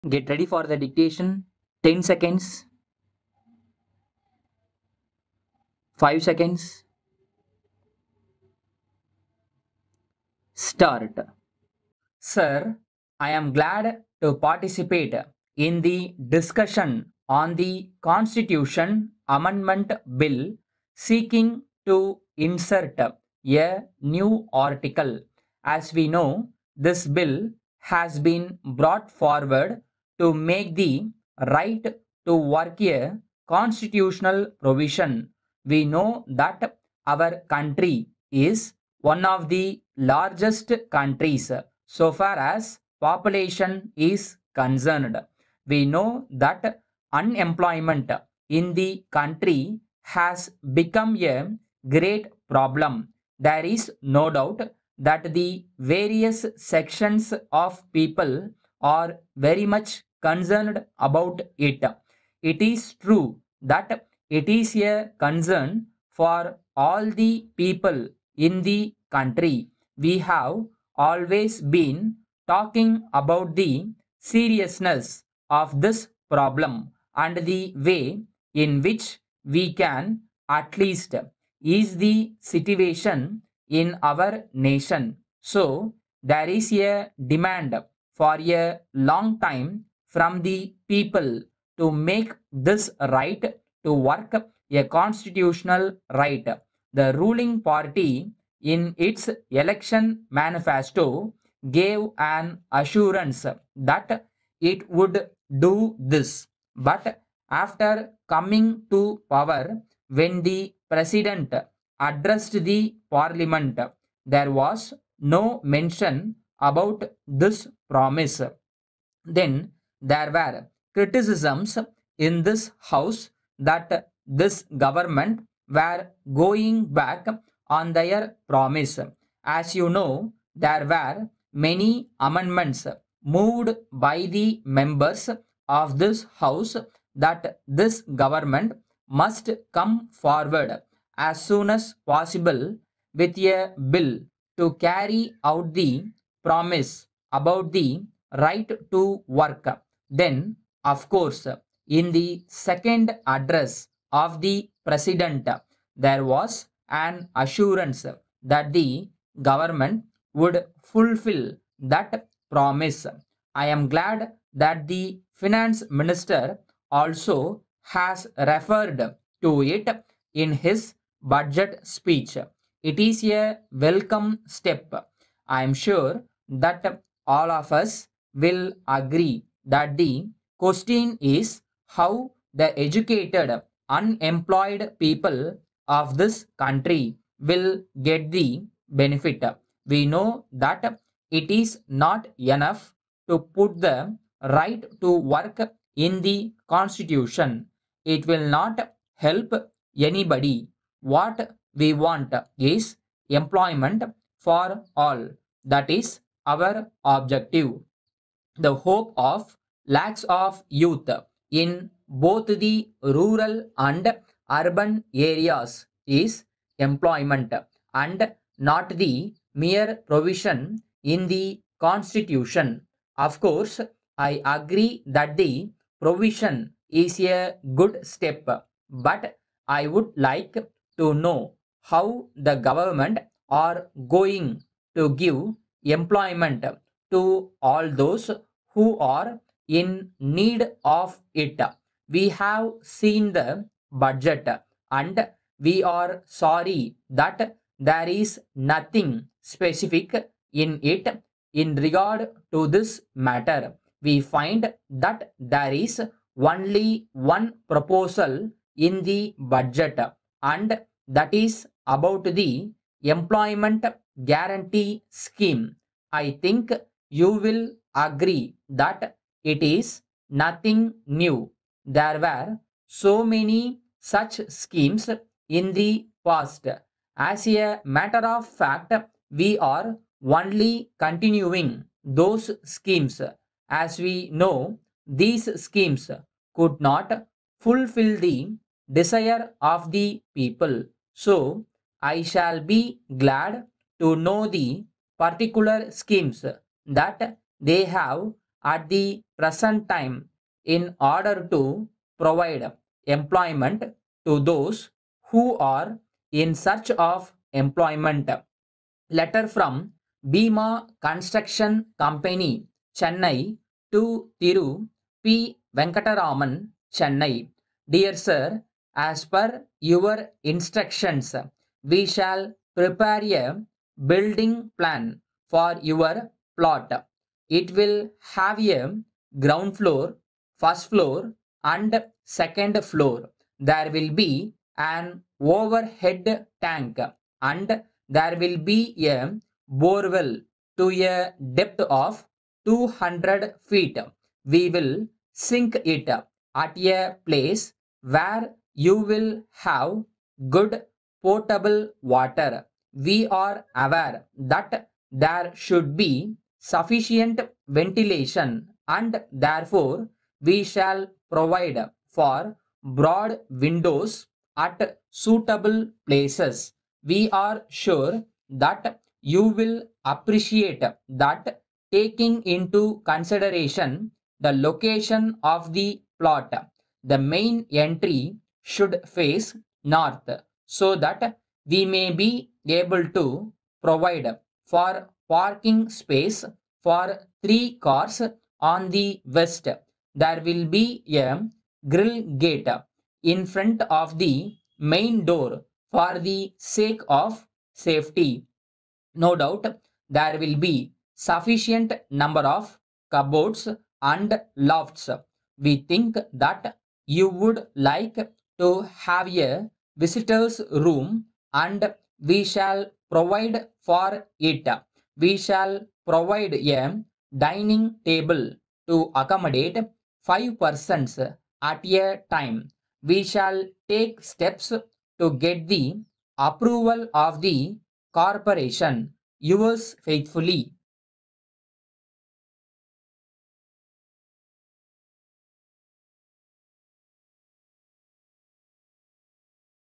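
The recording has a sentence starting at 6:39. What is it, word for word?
No doubt there will be sufficient number of cupboards and lofts.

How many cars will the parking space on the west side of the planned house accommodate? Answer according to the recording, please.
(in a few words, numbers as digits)
3.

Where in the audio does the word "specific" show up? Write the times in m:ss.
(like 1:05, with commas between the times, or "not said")
4:09.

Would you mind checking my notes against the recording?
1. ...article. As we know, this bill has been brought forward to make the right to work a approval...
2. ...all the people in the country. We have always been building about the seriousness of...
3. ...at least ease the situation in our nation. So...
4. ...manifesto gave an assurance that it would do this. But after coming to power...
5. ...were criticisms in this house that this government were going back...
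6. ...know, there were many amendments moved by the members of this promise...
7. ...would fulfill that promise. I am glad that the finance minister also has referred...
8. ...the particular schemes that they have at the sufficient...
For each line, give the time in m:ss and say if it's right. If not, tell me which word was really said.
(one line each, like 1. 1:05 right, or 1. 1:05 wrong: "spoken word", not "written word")
1. 0:24 wrong: "constitutional", not "approval"
2. 1:06 wrong: "talking", not "building"
3. 1:20 right
4. 1:40 right
5. 2:00 right
6. 2:09 wrong: "house", not "promise"
7. 2:40 right
8. 4:54 wrong: "present", not "sufficient".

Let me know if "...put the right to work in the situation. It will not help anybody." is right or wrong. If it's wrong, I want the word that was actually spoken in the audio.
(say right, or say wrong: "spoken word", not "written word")
wrong: "constitution", not "situation".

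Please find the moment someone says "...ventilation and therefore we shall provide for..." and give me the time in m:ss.
5:57.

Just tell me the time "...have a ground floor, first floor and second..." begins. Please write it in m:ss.
5:28.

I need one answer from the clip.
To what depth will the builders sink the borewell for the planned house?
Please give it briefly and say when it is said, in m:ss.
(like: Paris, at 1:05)
200 feet, at 5:42.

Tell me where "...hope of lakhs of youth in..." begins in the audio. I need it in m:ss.
3:28.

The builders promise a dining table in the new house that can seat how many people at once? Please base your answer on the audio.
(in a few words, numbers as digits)
5.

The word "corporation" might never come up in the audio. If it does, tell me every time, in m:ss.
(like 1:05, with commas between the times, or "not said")
7:08.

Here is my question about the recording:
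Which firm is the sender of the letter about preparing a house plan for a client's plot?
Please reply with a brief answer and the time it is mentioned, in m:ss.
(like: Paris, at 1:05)
Bima Construction Company, at 5:10.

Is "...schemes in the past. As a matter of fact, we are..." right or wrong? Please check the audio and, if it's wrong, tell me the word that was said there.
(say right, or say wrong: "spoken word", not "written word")
right.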